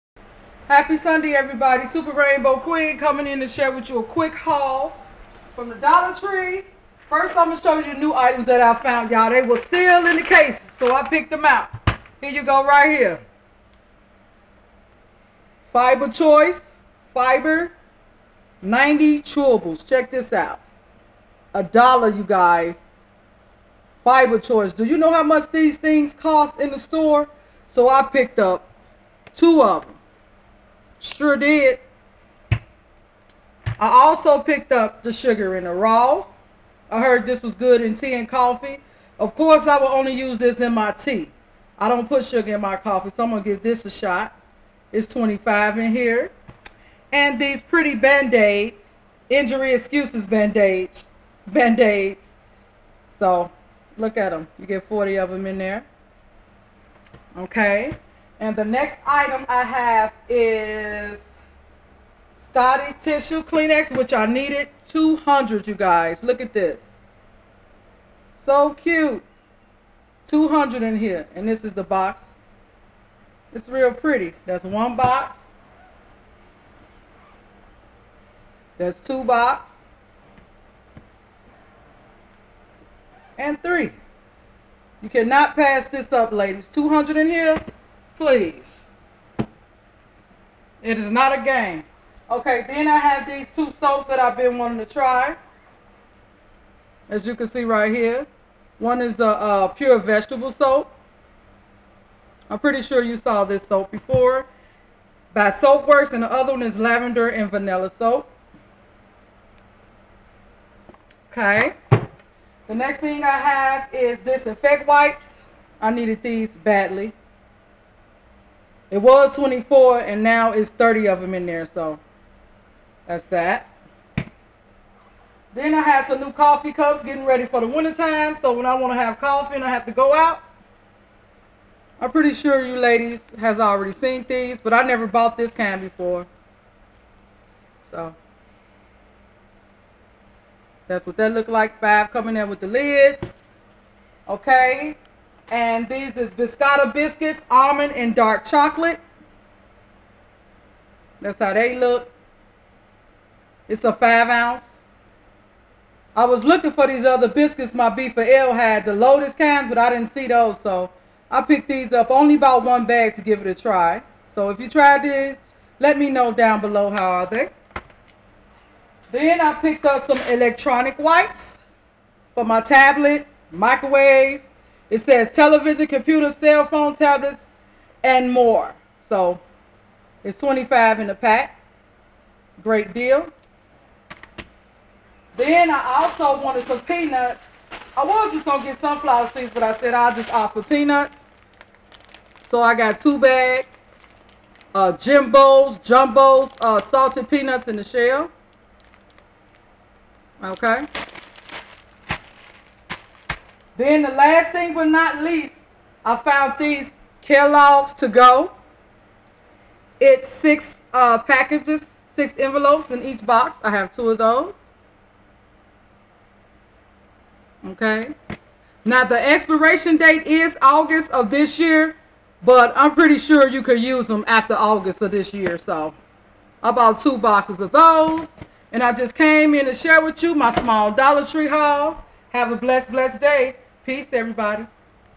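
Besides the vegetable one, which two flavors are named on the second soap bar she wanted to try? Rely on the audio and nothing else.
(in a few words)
Lavender and Vanilla.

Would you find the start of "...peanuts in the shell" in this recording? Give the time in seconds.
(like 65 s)
197 s.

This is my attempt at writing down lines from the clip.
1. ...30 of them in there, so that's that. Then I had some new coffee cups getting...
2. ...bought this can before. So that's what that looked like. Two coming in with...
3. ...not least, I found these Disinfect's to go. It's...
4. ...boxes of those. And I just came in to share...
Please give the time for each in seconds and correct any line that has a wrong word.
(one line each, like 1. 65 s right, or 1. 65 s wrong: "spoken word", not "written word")
1. 120 s right
2. 135 s wrong: "Five", not "Two"
3. 204 s wrong: "Kellogg", not "Disinfect"
4. 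227 s right.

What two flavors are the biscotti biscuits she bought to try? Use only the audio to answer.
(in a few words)
Almond and dark chocolate.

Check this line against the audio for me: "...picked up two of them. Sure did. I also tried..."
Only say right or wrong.
wrong.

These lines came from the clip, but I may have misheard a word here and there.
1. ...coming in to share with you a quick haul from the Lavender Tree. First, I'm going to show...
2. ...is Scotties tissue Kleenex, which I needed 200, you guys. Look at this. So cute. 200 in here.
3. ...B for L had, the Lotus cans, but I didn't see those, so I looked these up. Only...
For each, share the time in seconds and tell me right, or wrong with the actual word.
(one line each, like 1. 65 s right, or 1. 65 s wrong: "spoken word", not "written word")
1. 2 s wrong: "Dollar", not "Lavender"
2. 60 s right
3. 157 s wrong: "picked", not "looked".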